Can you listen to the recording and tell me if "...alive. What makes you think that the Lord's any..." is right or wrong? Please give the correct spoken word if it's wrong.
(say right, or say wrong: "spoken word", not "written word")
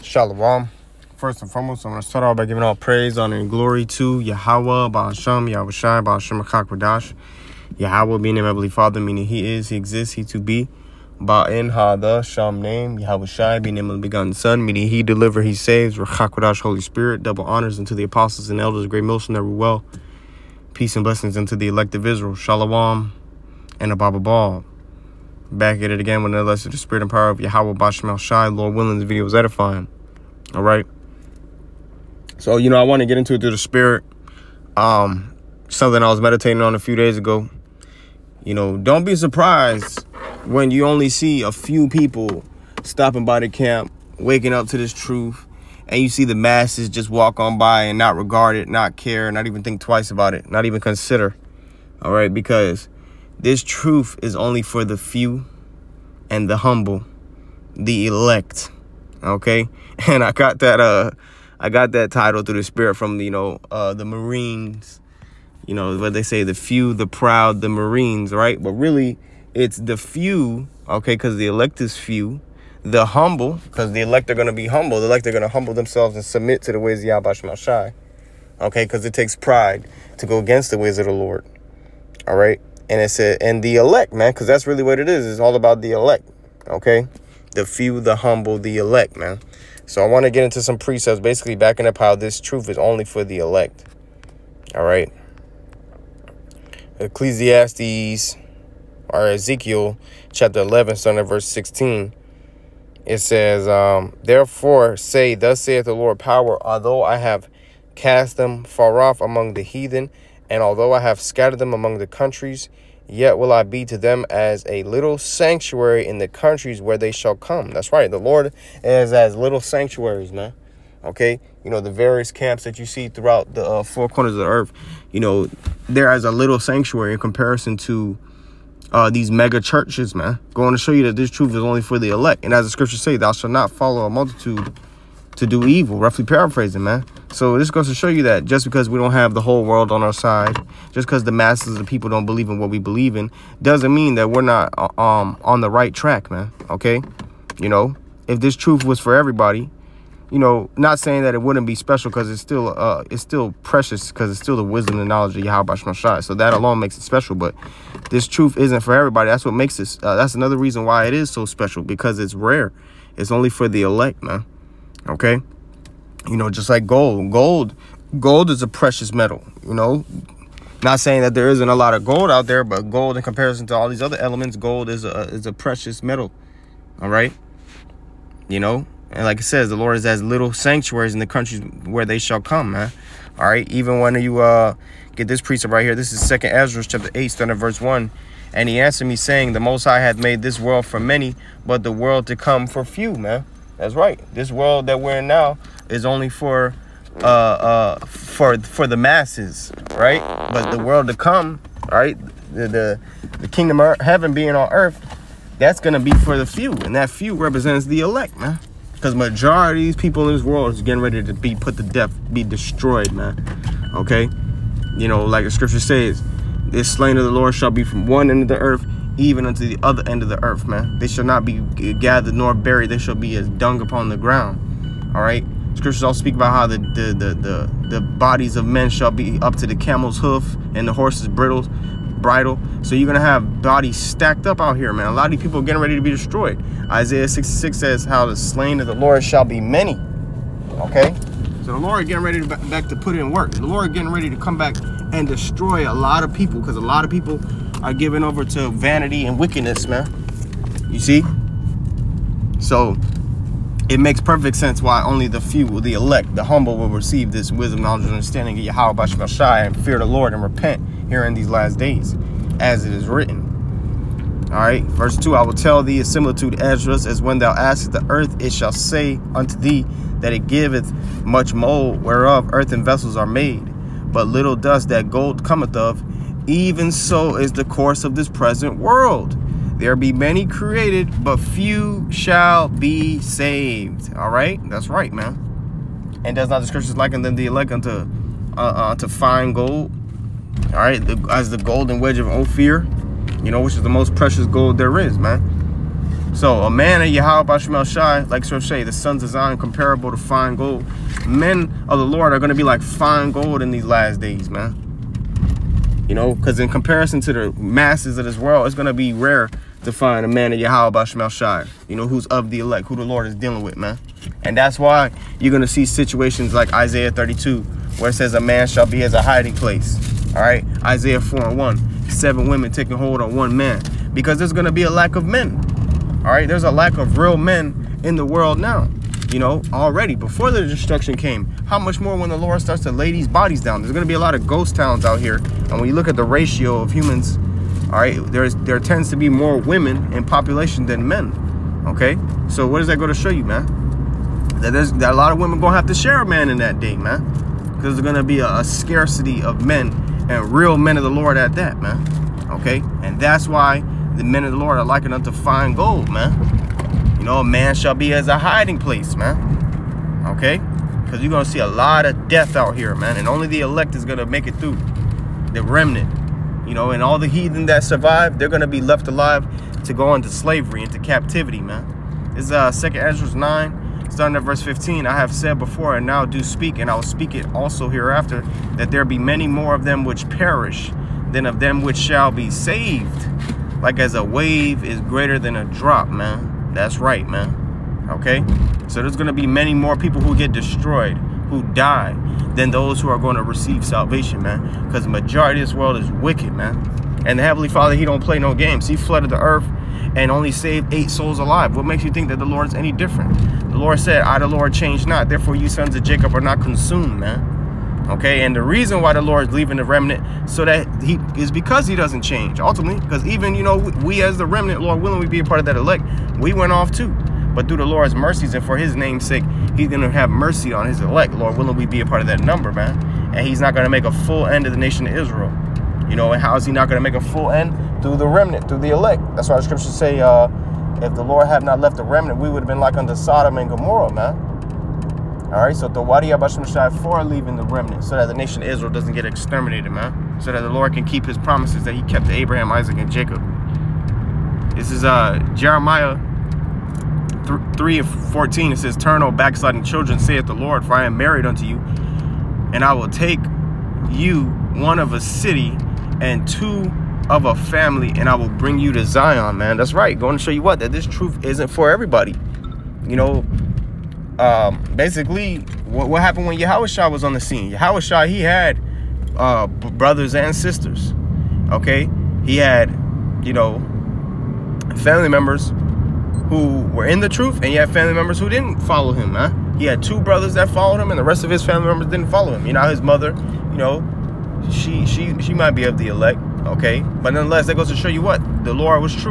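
right.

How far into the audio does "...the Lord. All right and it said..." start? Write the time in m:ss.
1:21.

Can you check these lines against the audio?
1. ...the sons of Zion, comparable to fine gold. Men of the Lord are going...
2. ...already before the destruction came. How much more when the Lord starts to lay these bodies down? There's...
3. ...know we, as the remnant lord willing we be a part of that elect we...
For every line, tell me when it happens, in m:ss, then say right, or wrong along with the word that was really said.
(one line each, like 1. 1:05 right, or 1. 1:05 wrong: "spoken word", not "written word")
1. 4:58 right
2. 5:29 right
3. 6:53 right.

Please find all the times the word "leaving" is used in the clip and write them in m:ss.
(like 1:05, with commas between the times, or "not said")
6:49, 7:17.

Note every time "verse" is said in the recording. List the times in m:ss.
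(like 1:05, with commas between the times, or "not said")
1:41, 3:07, 4:24, 6:14.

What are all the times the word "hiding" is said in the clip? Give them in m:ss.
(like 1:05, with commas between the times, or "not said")
5:19, 5:58.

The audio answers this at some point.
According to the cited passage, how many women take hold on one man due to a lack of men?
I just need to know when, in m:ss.
5:22.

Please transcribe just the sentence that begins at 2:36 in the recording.
So that alone makes it special.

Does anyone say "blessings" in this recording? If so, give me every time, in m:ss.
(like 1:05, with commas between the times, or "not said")
0:21.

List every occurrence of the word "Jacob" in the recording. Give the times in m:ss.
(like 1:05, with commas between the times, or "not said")
6:46, 7:23.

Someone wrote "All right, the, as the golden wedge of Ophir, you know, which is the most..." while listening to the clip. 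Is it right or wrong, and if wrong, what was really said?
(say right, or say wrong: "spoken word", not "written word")
right.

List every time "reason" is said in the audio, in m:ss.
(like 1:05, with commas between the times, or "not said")
2:40, 6:48.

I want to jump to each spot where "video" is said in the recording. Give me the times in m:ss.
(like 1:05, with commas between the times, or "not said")
0:29.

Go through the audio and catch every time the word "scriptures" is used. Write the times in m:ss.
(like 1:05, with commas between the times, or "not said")
2:12, 3:35, 3:45, 4:46, 7:09.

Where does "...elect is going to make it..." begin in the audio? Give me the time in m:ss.
6:03.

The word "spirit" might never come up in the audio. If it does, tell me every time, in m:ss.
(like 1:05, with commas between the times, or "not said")
0:16, 0:26, 0:33, 1:02.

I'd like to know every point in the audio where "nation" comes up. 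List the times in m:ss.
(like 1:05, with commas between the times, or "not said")
7:04, 7:18.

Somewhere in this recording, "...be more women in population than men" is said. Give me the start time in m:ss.
5:39.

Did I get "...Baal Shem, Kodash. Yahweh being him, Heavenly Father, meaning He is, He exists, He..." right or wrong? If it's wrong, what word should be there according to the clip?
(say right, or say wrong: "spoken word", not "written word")
right.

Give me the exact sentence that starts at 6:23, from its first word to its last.
Like as a wave is greater than a drop, man.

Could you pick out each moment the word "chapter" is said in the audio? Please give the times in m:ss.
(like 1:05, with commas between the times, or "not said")
1:40, 3:06.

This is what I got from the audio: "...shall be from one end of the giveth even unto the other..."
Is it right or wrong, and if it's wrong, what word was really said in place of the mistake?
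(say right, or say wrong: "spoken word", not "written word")
wrong: "earth", not "giveth".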